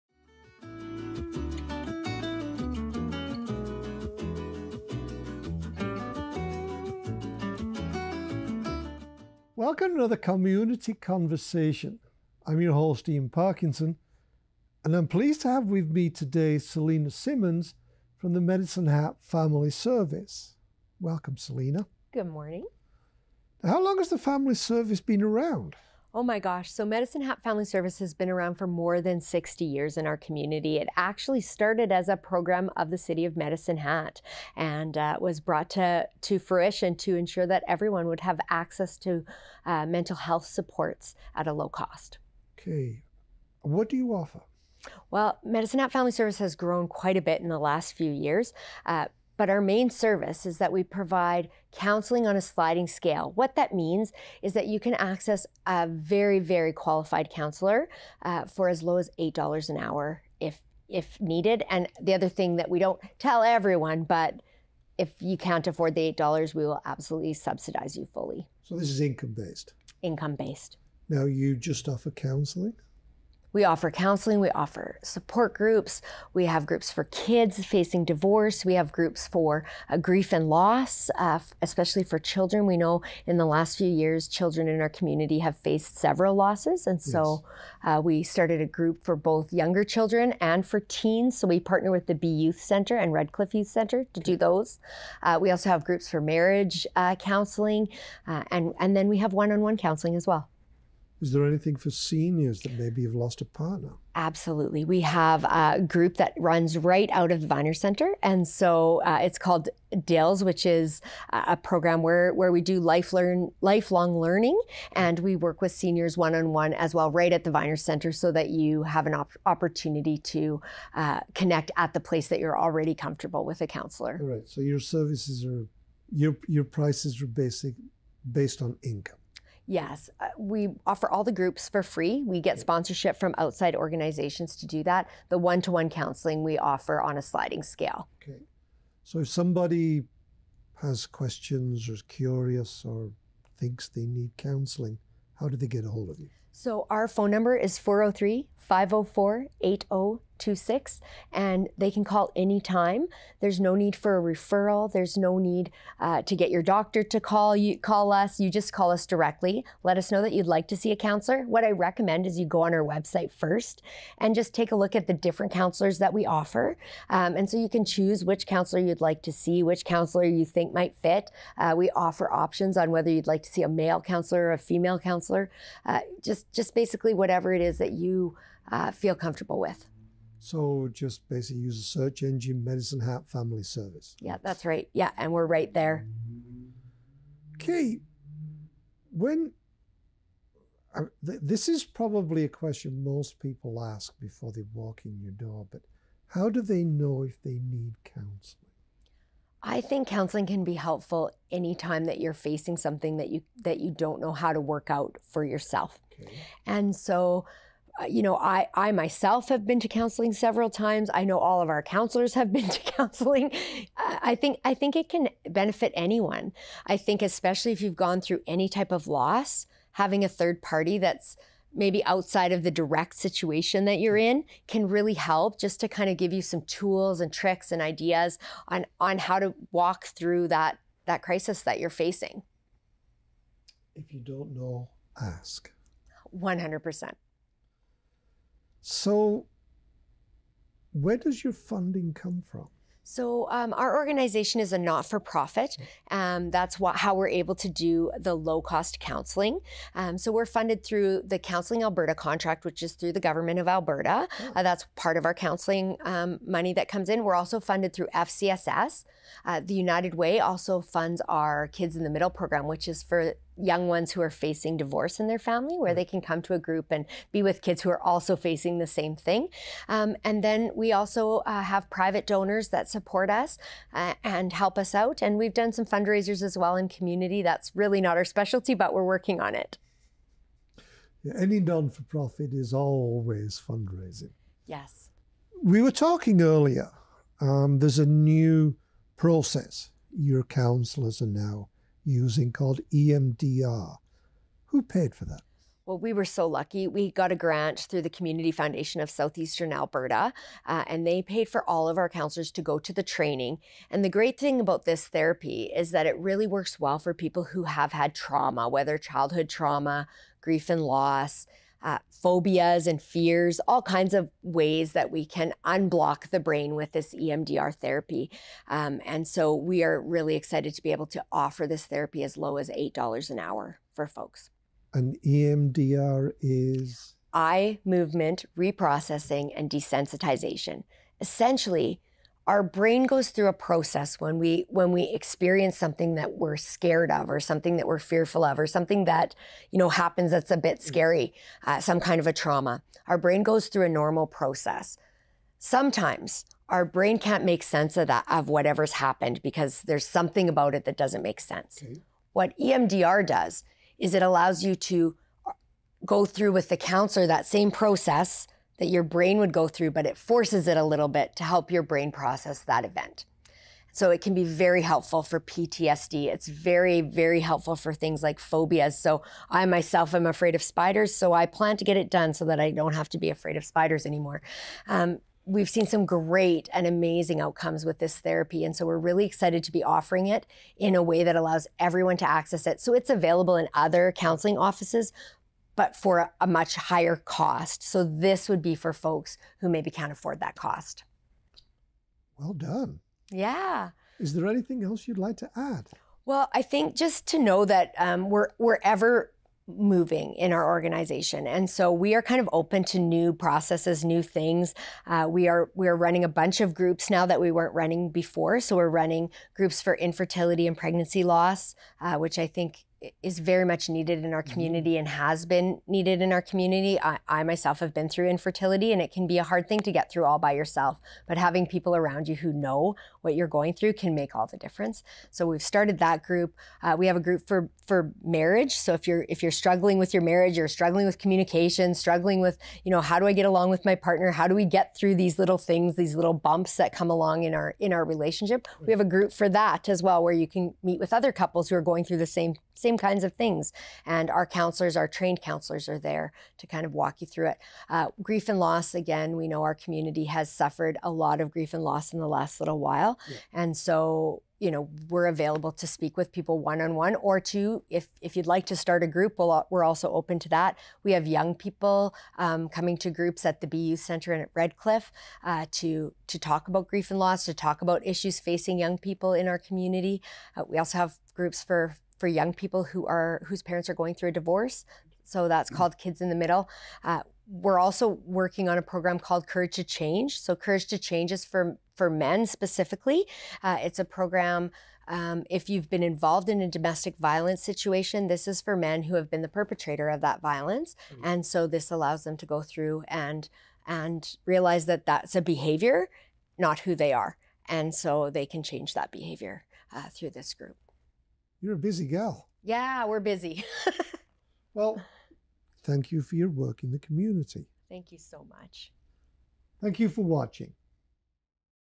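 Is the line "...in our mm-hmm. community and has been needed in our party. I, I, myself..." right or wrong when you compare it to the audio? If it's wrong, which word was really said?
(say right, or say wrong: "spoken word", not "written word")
wrong: "community", not "party".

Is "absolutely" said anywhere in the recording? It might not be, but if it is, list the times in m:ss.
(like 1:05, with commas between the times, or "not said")
1:06, 1:44.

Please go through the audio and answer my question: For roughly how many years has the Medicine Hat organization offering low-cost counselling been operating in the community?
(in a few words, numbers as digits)
more than 60 years.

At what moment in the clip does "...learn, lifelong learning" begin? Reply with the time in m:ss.
1:53.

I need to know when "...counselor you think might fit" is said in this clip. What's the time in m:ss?
2:49.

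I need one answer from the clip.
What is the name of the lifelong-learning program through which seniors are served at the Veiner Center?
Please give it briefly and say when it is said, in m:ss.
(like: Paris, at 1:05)
DILS, at 1:50.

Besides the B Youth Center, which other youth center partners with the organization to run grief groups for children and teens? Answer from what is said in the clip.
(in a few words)
Redcliffe Youth Center.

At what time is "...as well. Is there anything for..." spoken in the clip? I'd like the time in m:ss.
1:40.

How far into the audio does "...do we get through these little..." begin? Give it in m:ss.
7:14.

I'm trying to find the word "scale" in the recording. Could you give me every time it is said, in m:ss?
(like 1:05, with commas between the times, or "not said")
0:52, 2:17.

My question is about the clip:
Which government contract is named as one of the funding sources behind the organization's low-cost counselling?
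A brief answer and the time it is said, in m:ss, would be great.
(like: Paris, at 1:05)
Counseling Alberta, at 4:11.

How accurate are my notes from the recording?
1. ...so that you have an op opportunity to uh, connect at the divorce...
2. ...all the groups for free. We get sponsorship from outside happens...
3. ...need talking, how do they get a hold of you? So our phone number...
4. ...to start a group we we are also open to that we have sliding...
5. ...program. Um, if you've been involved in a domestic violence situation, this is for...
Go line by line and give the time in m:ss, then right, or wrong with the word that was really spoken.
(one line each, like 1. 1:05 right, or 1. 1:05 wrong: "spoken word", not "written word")
1. 1:58 wrong: "place", not "divorce"
2. 2:11 wrong: "organizations", not "happens"
3. 2:24 wrong: "counseling", not "talking"
4. 7:38 wrong: "young", not "sliding"
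5. 8:04 right.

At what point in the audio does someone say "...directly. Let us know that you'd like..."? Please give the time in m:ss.
2:39.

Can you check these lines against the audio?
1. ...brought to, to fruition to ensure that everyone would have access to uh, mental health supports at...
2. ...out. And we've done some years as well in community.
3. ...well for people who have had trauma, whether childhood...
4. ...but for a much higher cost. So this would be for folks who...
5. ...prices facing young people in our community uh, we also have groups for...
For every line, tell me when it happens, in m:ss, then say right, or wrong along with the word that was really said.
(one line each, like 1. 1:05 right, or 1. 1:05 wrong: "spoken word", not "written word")
1. 0:35 right
2. 4:34 wrong: "fundraisers", not "years"
3. 5:06 right
4. 6:25 right
5. 7:48 wrong: "issues", not "prices".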